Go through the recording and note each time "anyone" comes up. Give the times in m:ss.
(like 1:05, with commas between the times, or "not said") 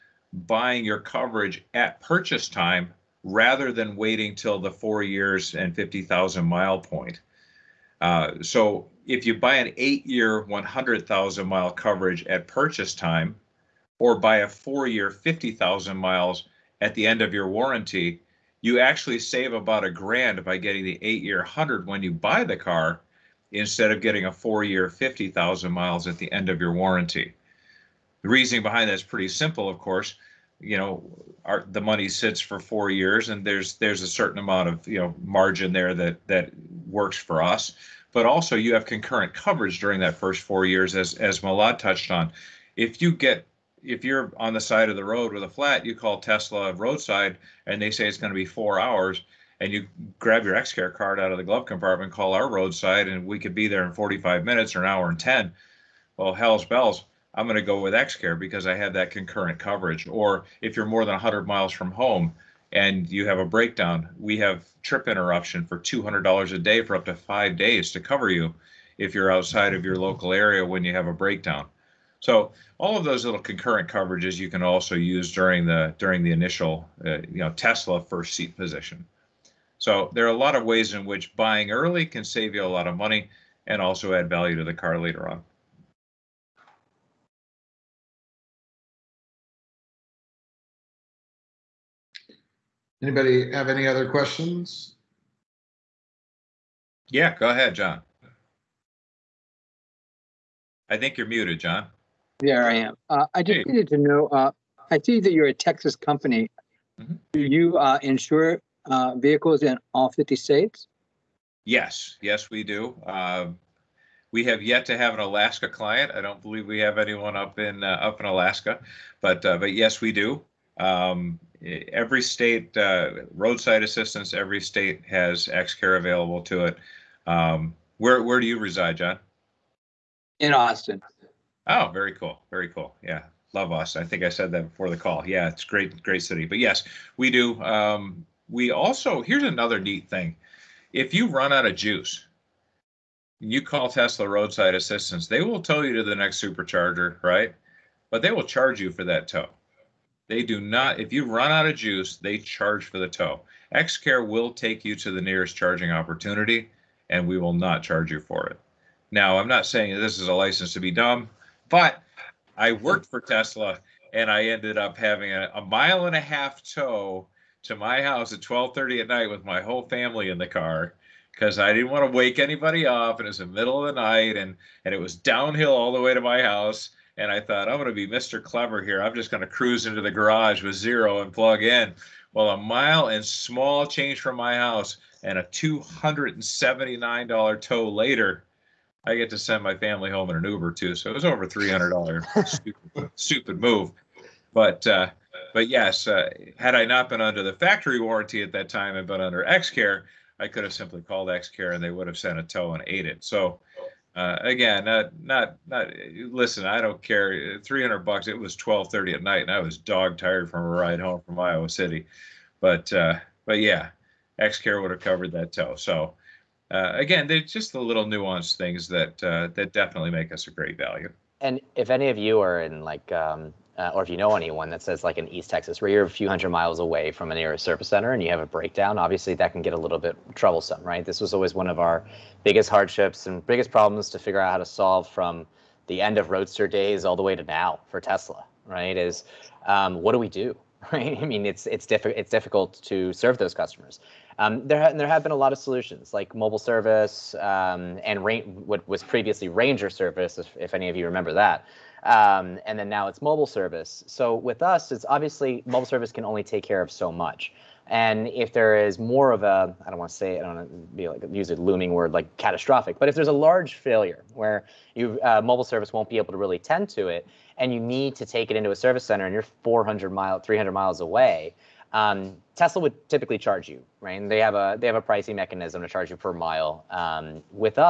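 1:57, 3:44.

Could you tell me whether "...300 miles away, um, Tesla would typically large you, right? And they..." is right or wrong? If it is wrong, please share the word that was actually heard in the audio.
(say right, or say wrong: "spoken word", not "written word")
wrong: "charge", not "large".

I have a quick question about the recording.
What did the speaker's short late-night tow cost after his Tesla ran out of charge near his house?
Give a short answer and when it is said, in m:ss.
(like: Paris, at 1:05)
$279, at 3:05.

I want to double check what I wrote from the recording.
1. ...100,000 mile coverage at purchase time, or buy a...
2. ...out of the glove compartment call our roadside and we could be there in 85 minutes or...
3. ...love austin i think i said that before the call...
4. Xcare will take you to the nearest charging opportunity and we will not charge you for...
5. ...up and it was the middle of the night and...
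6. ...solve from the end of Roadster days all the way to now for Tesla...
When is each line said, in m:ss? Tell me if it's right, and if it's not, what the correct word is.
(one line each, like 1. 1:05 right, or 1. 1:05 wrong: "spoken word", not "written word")
1. 0:10 right
2. 0:51 wrong: "45", not "85"
3. 2:13 right
4. 2:33 right
5. 2:52 right
6. 3:54 right.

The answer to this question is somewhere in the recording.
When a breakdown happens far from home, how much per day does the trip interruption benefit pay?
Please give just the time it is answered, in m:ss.
1:05.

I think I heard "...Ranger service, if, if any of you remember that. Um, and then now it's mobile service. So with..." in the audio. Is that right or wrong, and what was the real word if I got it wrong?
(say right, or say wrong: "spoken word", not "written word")
right.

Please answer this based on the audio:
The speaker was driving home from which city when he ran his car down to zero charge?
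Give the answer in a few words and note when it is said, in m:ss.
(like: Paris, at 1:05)
Iowa City, at 3:31.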